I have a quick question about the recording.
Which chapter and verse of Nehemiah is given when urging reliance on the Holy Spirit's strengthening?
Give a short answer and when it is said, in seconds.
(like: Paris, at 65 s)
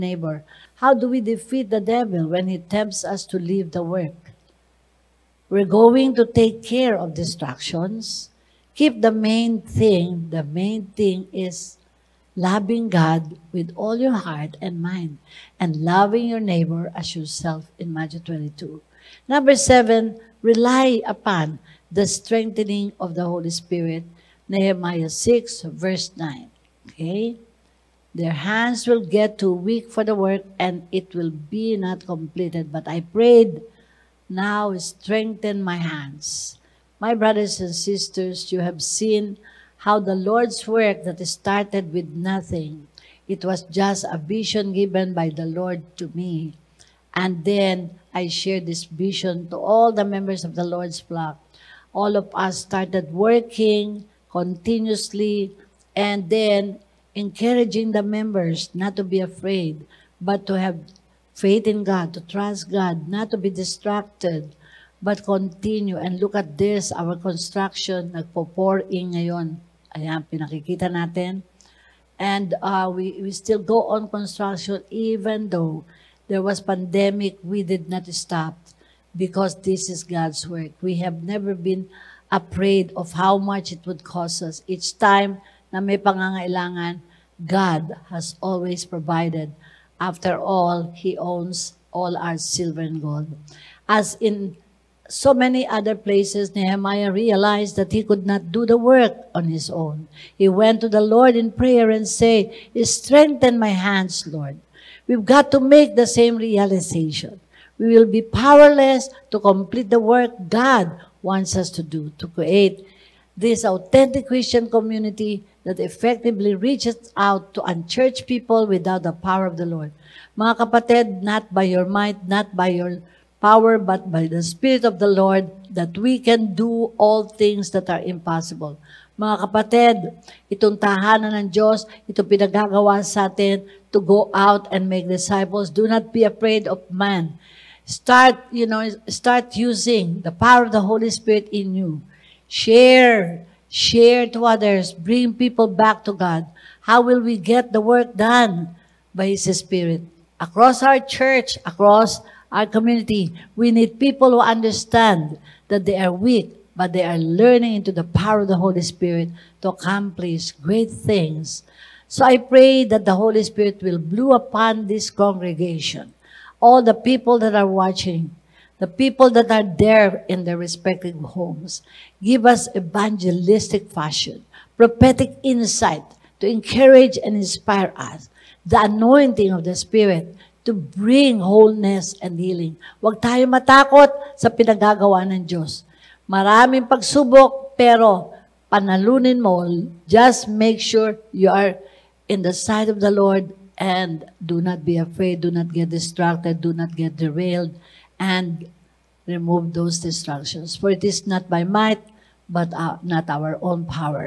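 Nehemiah 6:9, at 24 s.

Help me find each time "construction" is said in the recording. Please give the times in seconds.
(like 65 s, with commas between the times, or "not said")
67 s, 74 s.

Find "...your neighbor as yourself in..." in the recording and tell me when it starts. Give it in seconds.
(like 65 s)
16 s.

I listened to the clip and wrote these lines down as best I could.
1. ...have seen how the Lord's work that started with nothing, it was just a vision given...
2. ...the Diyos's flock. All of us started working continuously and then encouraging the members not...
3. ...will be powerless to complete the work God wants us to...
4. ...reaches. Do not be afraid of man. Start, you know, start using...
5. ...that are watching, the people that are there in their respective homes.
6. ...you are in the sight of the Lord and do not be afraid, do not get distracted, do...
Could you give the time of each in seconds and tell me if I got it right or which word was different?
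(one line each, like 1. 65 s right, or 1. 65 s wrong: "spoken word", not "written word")
1. 38 s right
2. 50 s wrong: "Lord", not "Diyos"
3. 107 s right
4. 135 s wrong: "disciples", not "reaches"
5. 167 s right
6. 191 s right.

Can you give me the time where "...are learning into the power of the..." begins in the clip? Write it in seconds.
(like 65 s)
157 s.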